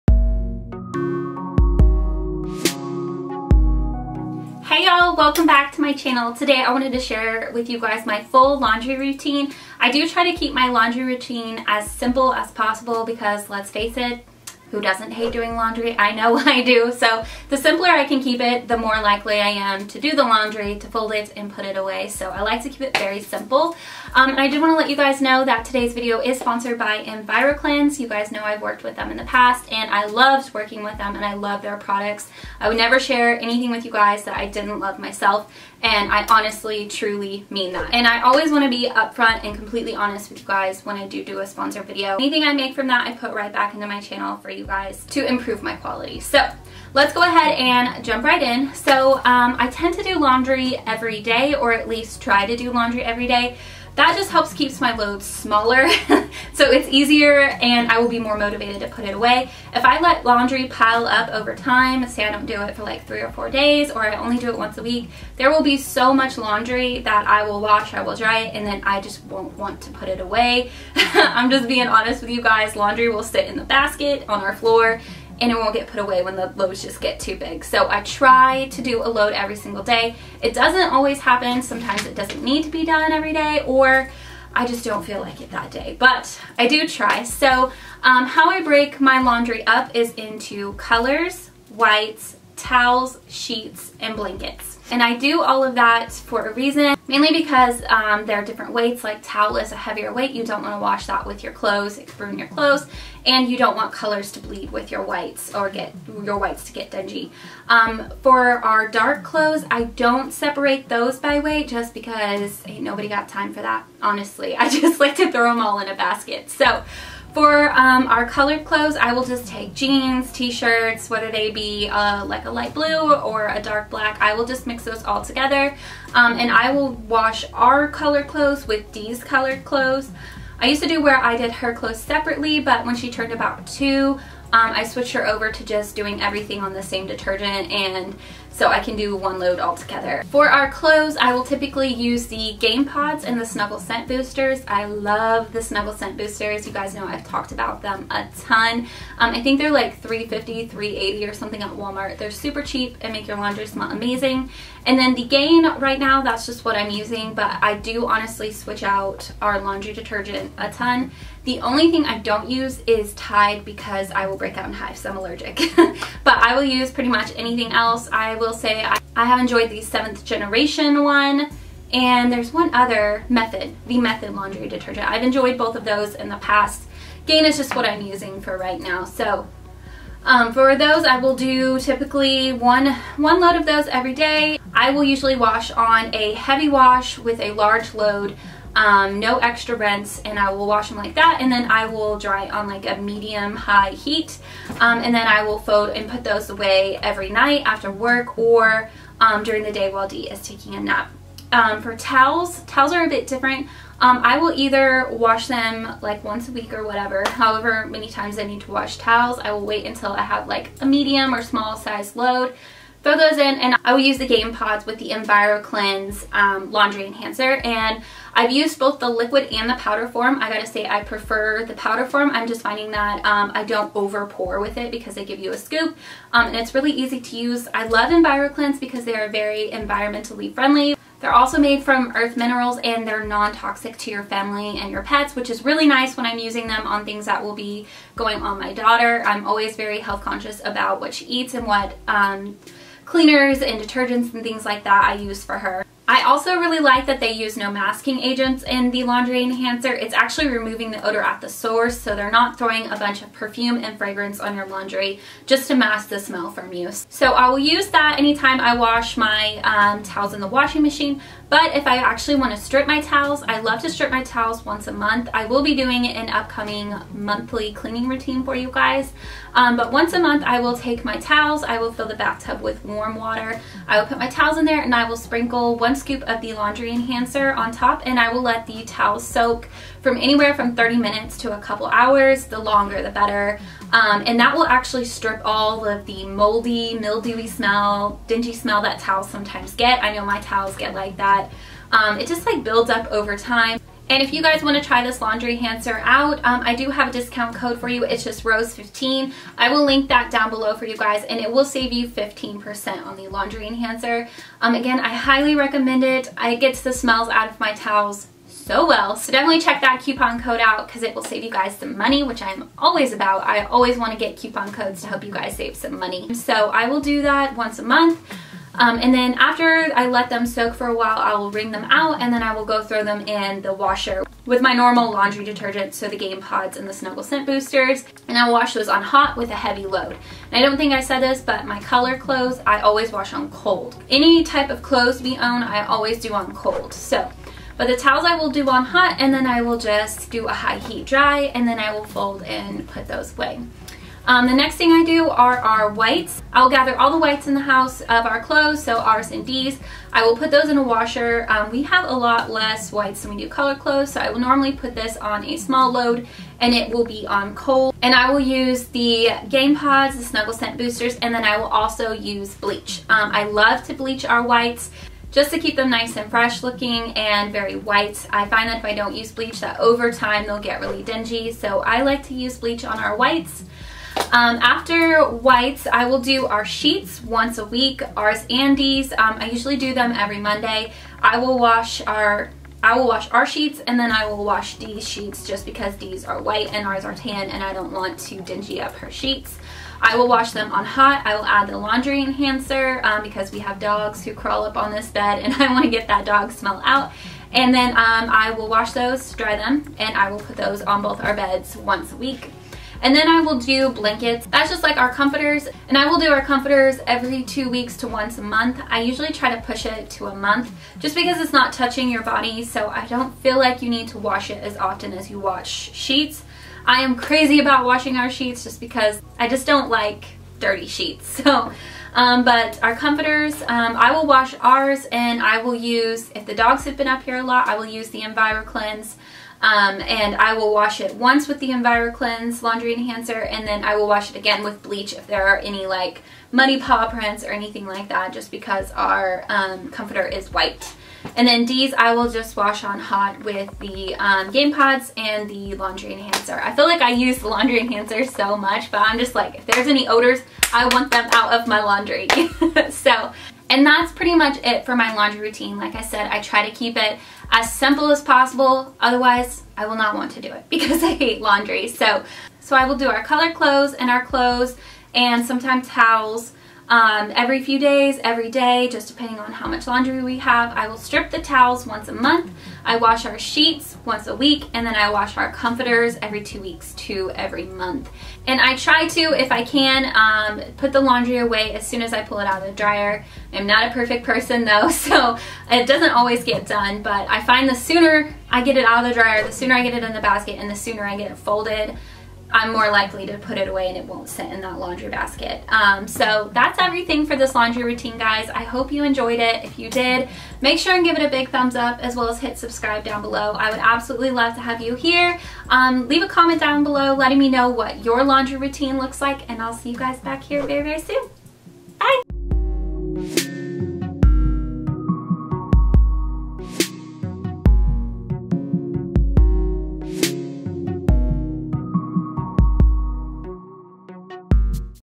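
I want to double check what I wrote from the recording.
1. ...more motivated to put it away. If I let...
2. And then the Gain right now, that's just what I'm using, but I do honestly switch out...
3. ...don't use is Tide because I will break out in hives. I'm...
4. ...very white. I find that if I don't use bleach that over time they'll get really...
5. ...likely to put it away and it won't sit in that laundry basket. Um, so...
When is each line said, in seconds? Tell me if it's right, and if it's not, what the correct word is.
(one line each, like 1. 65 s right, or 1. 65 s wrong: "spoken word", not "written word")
1. 58 s right
2. 154 s right
3. 162 s right
4. 367 s right
5. 492 s right.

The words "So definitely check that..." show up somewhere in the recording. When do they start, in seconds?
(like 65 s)
309 s.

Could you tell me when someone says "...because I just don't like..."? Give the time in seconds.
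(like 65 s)
418 s.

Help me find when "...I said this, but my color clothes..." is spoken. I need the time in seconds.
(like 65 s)
330 s.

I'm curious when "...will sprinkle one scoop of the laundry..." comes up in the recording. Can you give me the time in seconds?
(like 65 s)
275 s.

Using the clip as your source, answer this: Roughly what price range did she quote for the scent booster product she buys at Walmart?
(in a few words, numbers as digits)
$3.50-$3.80.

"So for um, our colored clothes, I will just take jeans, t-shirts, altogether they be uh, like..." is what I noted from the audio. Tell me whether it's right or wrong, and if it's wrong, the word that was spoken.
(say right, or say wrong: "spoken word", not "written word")
wrong: "whether", not "altogether".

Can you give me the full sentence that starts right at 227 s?
I love EnviroKlenz because they are very environmentally friendly.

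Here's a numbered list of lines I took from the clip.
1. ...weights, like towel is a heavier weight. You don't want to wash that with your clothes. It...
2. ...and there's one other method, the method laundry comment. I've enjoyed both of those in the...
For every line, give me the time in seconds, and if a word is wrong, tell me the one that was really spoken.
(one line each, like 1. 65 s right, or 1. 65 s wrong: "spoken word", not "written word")
1. 98 s right
2. 171 s wrong: "detergent", not "comment".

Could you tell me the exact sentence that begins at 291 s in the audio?
Um, it just like builds up over time.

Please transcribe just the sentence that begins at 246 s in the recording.
I also really like that they use no masking agents in the laundry enhancer.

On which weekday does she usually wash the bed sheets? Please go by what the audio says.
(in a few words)
Monday.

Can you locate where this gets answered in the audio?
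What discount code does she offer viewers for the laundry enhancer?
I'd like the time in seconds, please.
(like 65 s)
298 s.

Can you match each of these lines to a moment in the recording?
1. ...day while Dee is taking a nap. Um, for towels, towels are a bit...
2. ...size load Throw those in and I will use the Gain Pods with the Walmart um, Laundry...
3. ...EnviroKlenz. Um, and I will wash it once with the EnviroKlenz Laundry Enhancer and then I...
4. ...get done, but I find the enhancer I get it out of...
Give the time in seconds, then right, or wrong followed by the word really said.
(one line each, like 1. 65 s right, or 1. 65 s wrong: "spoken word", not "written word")
1. 199 s right
2. 211 s wrong: "EnviroKlenz", not "Walmart"
3. 428 s right
4. 486 s wrong: "sooner", not "enhancer".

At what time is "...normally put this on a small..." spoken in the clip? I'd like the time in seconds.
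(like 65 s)
354 s.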